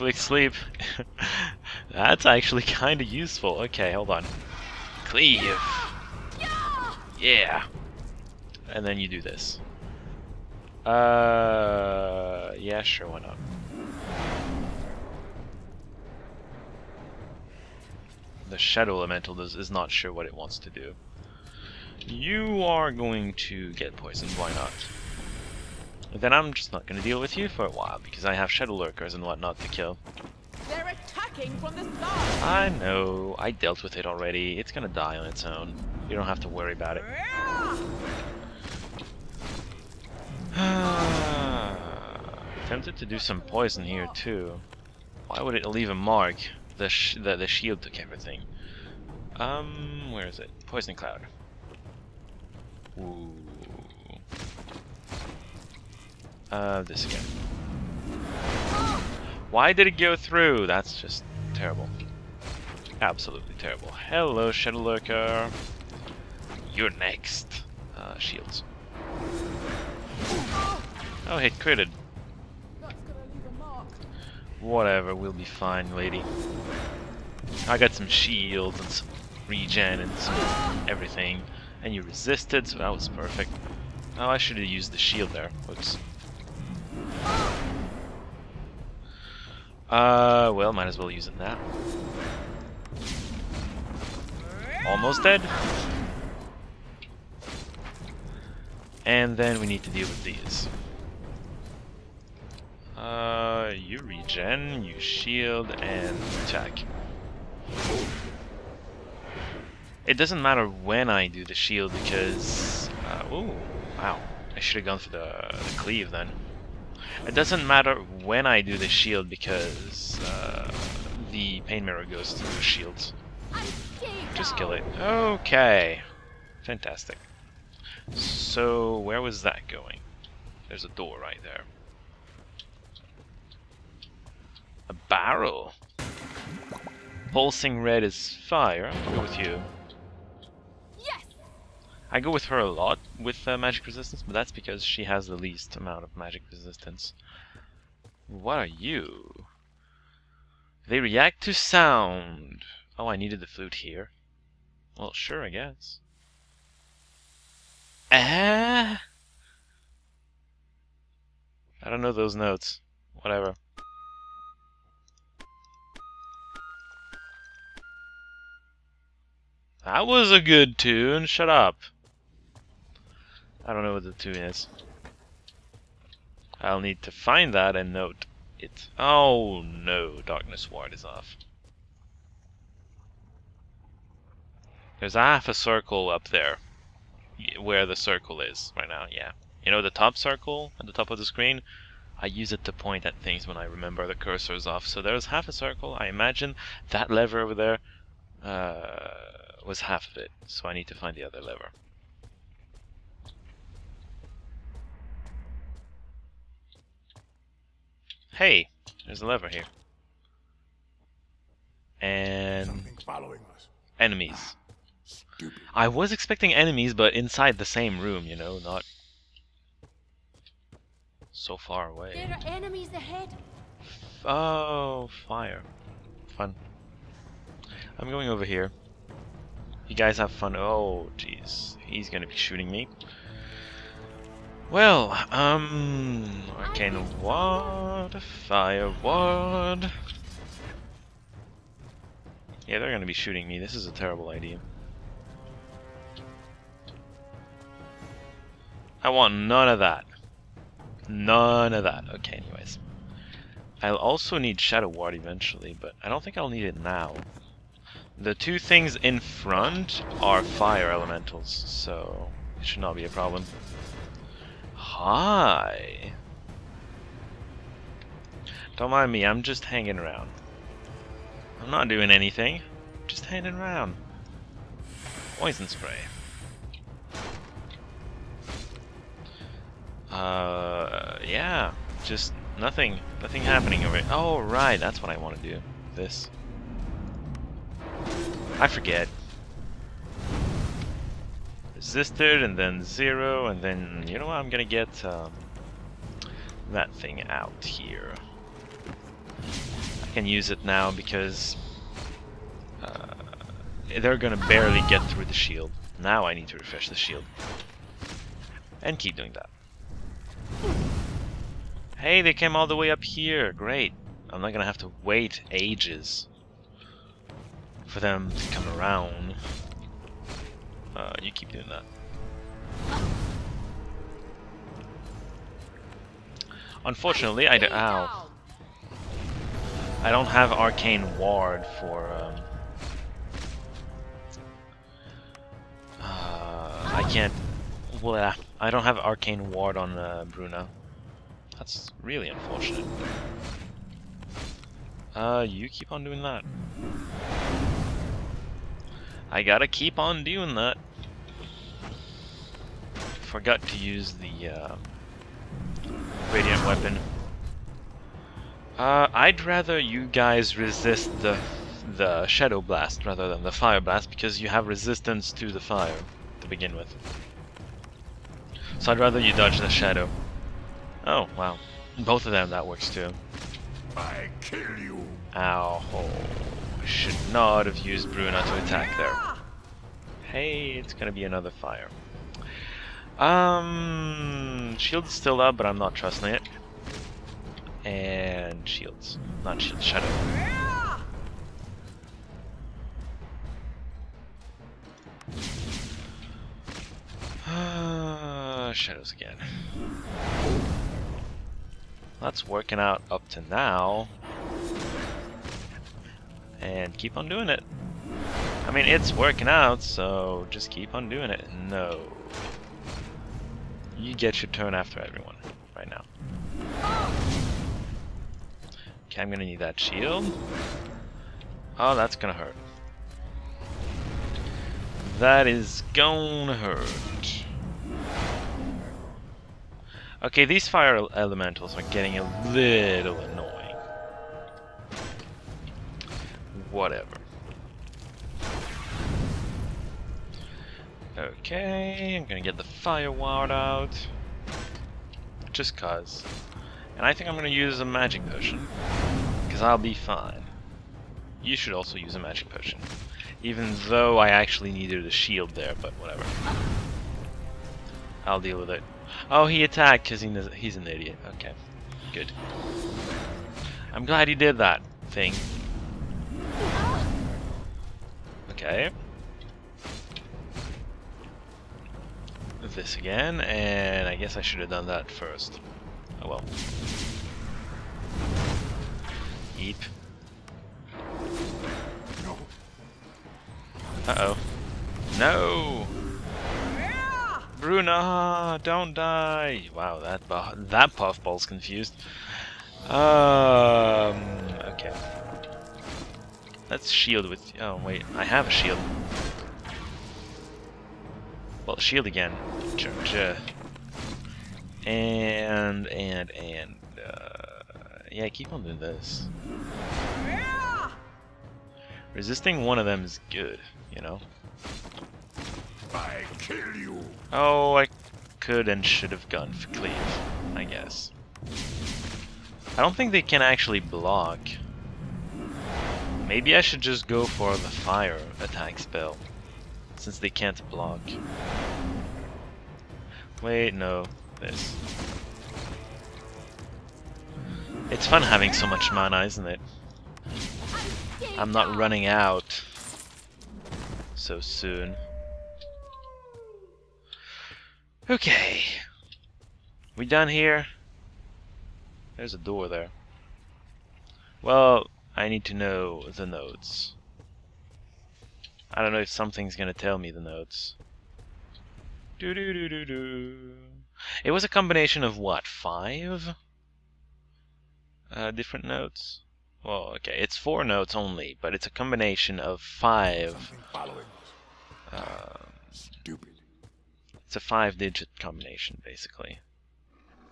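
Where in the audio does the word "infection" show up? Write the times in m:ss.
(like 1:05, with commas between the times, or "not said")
not said.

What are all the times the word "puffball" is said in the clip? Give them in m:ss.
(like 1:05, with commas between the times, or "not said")
8:10.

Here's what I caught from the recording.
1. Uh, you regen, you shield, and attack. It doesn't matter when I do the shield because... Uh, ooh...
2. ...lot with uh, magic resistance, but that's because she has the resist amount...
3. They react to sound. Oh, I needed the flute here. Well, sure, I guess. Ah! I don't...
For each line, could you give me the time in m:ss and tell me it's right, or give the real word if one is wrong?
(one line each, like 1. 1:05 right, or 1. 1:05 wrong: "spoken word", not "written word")
1. 1:42 right
2. 2:22 wrong: "least", not "resist"
3. 2:30 right.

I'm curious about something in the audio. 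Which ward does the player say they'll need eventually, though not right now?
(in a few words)
Shadow Ward.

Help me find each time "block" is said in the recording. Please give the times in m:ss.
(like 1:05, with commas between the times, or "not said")
8:43, 8:50.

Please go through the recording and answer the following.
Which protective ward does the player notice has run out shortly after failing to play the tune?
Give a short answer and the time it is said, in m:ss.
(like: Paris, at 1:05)
Darkness Ward, at 3:00.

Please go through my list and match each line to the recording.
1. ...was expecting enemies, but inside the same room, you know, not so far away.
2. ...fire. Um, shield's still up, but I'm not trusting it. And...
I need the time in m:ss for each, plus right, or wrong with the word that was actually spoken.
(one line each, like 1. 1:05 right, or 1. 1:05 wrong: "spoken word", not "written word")
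1. 3:35 right
2. 6:21 right.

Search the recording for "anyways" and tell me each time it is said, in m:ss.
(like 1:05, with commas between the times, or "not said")
4:12.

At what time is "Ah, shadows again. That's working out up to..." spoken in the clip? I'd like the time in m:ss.
6:37.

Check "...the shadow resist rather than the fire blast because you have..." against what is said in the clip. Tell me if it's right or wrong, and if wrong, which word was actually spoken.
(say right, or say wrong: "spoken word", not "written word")
wrong: "blast", not "resist".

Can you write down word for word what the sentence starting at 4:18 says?
The two things in front are fire elementals, so it should not be a problem.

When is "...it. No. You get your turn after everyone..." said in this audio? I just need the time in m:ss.
6:51.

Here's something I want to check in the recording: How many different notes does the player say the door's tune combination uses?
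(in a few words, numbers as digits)
4.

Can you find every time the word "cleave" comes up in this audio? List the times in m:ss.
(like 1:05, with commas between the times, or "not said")
0:05, 1:55, 8:39.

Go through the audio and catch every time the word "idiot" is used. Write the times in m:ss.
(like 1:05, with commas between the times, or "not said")
7:40.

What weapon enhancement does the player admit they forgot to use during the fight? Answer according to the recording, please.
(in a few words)
Radiant weapon.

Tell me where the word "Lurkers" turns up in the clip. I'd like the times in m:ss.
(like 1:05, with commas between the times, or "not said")
0:28, 1:04.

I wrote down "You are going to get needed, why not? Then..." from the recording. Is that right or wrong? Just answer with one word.
wrong.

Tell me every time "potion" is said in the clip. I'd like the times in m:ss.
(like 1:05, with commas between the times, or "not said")
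7:28, 7:32.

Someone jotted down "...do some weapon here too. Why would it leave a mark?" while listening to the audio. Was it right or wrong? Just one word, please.
wrong.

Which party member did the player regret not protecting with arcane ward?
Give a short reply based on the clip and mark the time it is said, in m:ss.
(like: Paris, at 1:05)
Bruno, at 5:40.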